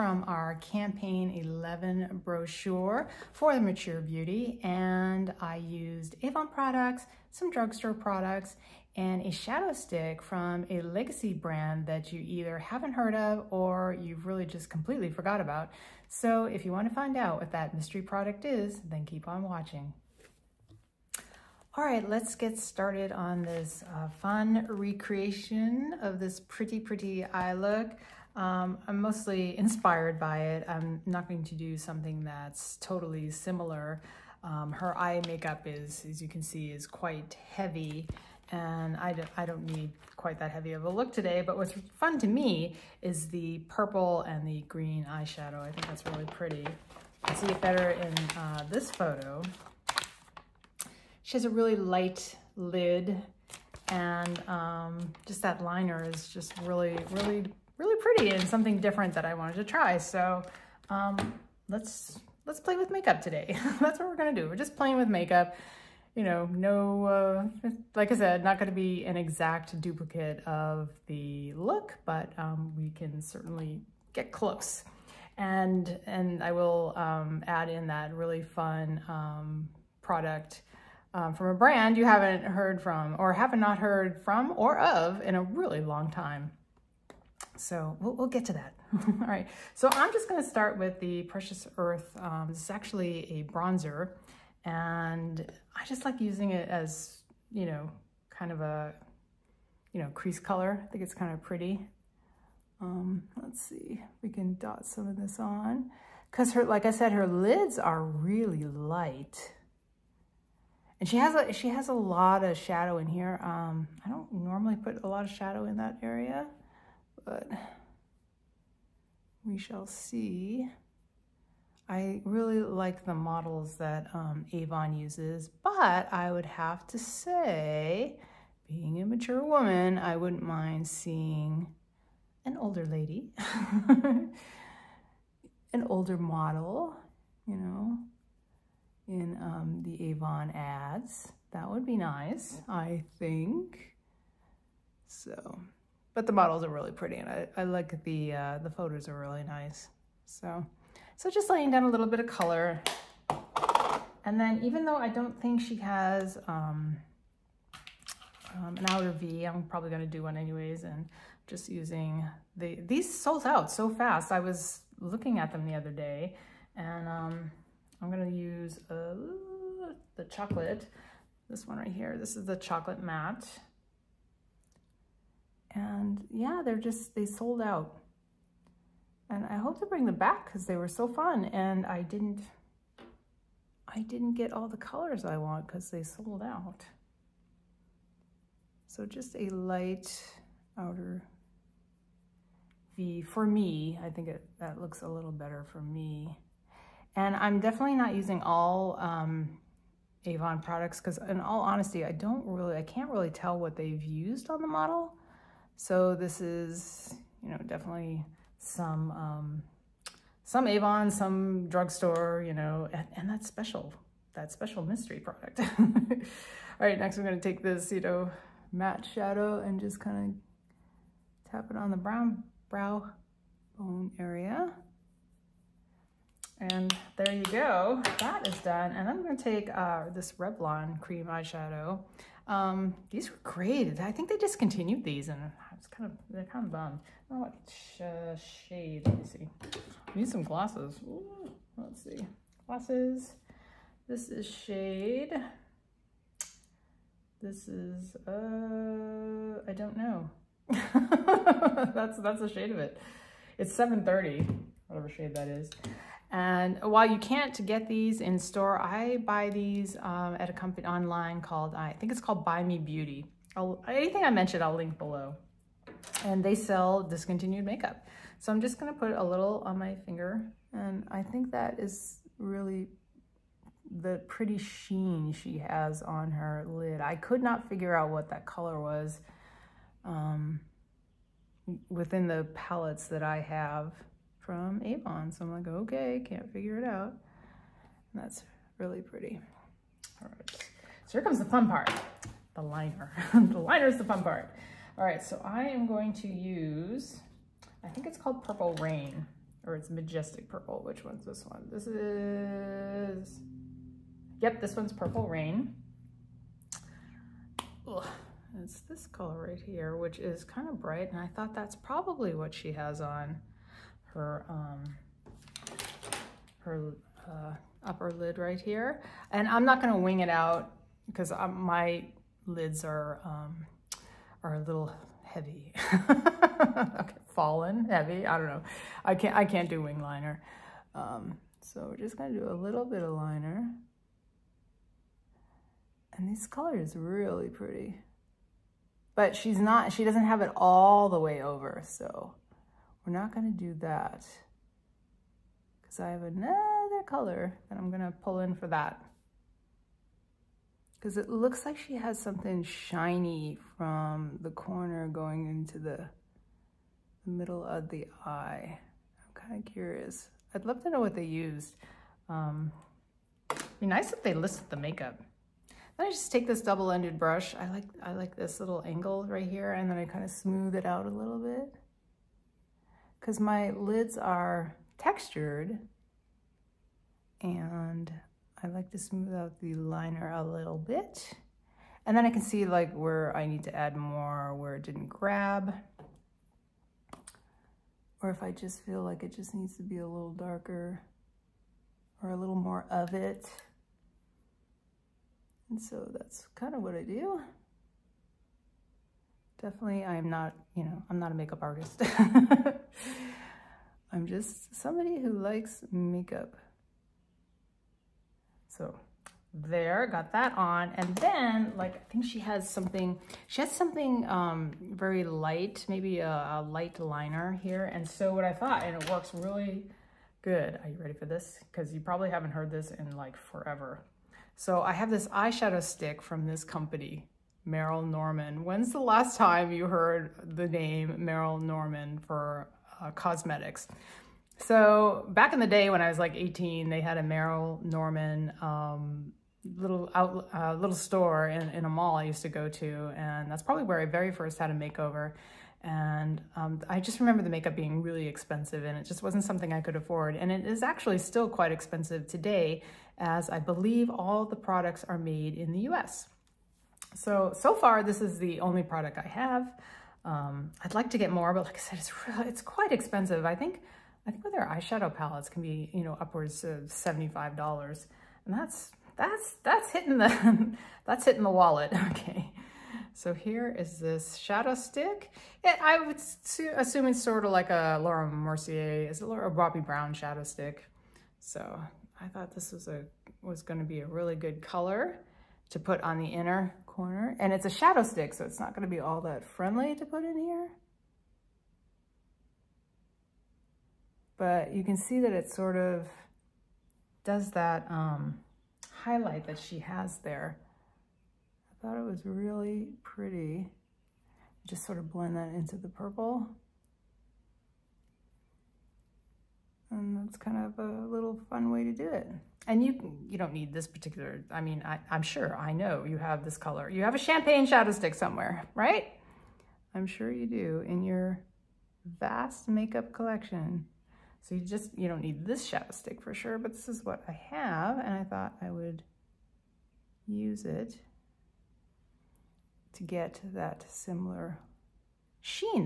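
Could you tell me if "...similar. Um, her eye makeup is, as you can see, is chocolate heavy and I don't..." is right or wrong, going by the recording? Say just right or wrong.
wrong.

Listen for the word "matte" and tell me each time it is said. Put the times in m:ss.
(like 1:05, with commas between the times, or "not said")
2:53, 3:38.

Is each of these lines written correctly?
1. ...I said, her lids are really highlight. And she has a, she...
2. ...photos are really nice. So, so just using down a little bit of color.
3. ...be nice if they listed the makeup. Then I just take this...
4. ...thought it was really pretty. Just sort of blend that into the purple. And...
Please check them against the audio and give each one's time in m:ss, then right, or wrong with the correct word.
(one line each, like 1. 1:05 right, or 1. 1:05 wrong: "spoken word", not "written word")
1. 1:46 wrong: "light", not "highlight"
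2. 2:28 wrong: "laying", not "using"
3. 6:03 right
4. 8:21 right.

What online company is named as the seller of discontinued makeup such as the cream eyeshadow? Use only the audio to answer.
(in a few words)
Buy Me Beauty.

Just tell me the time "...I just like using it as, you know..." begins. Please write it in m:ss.
1:35.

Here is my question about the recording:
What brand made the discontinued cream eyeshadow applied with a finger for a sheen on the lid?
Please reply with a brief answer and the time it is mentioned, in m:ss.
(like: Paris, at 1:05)
Revlon, at 3:50.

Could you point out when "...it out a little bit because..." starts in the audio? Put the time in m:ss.
6:10.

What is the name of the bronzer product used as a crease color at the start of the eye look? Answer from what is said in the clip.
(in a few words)
Precious Earth.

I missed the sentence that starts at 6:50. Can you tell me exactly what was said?
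And then, like, I think she has something, she has something um, very light, maybe a, a light liner here.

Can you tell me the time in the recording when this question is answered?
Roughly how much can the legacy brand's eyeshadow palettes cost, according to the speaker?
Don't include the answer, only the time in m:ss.
7:46.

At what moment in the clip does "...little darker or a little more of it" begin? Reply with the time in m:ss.
6:30.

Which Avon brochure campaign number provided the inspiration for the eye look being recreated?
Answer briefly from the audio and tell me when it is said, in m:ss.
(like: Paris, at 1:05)
11, at 0:00.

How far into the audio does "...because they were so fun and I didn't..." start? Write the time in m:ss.
3:00.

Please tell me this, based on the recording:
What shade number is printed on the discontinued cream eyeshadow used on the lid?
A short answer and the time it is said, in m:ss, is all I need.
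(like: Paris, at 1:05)
730, at 4:13.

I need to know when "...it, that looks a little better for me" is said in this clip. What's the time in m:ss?
3:14.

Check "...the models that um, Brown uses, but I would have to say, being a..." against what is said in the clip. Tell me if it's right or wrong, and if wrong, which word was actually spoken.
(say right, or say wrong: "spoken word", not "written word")
wrong: "Avon", not "Brown".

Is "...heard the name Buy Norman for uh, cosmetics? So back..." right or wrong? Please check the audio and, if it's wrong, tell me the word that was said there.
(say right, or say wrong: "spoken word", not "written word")
wrong: "Merle", not "Buy".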